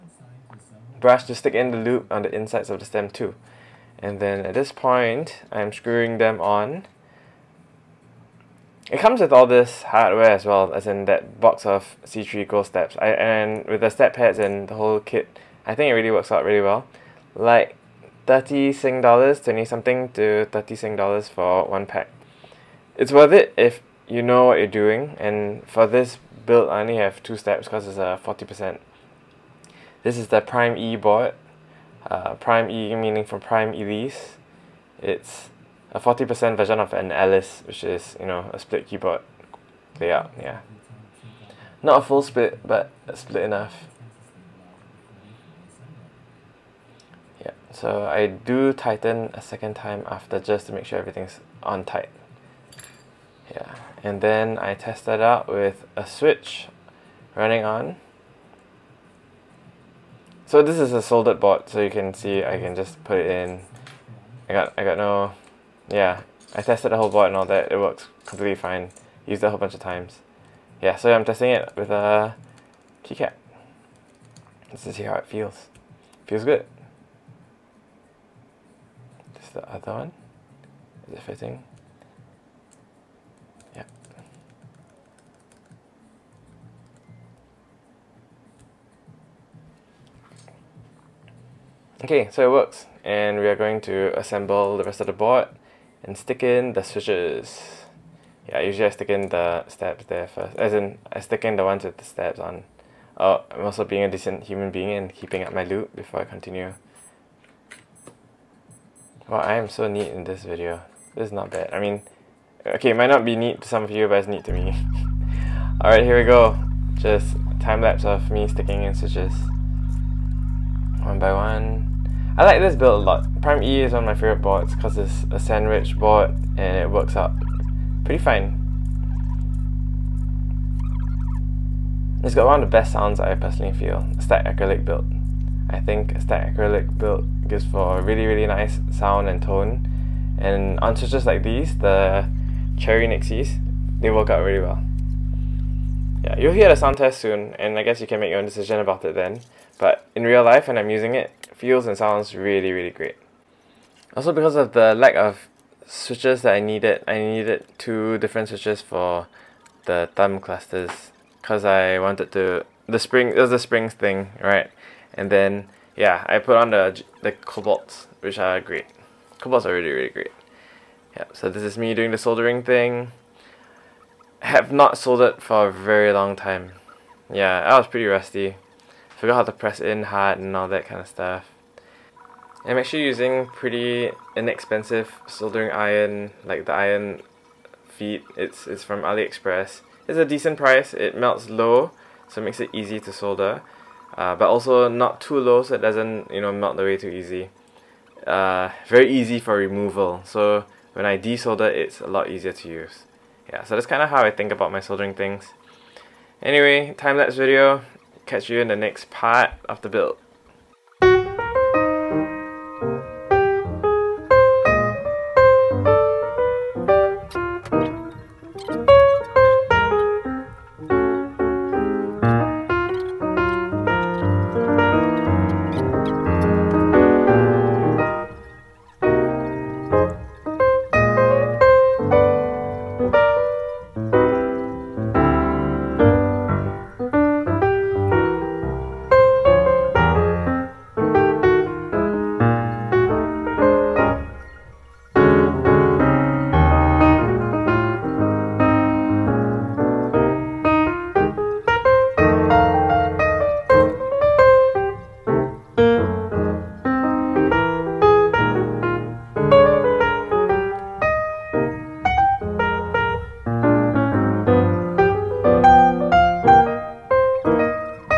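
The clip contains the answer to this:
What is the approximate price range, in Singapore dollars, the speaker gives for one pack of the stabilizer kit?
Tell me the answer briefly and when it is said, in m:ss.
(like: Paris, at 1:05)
20 to 30 Sing dollars, at 0:19.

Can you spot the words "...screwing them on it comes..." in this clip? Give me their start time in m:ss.
0:05.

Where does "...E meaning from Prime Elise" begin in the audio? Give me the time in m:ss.
0:32.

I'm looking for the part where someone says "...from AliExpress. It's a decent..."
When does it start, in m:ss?
3:08.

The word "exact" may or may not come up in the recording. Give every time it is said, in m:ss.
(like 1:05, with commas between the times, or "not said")
not said.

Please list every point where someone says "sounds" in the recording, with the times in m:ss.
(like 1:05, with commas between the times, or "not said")
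2:12, 2:18, 2:26, 2:31.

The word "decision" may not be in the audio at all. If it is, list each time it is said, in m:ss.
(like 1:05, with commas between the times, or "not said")
2:28.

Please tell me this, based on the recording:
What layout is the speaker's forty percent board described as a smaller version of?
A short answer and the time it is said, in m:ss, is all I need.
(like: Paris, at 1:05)
Alice, at 0:37.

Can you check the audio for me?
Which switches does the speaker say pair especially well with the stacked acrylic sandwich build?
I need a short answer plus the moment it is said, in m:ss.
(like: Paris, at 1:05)
Cherry Nixies, at 2:22.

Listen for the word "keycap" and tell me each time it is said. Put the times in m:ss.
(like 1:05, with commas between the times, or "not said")
1:13.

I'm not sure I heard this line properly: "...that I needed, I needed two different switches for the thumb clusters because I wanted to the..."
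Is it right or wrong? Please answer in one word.
right.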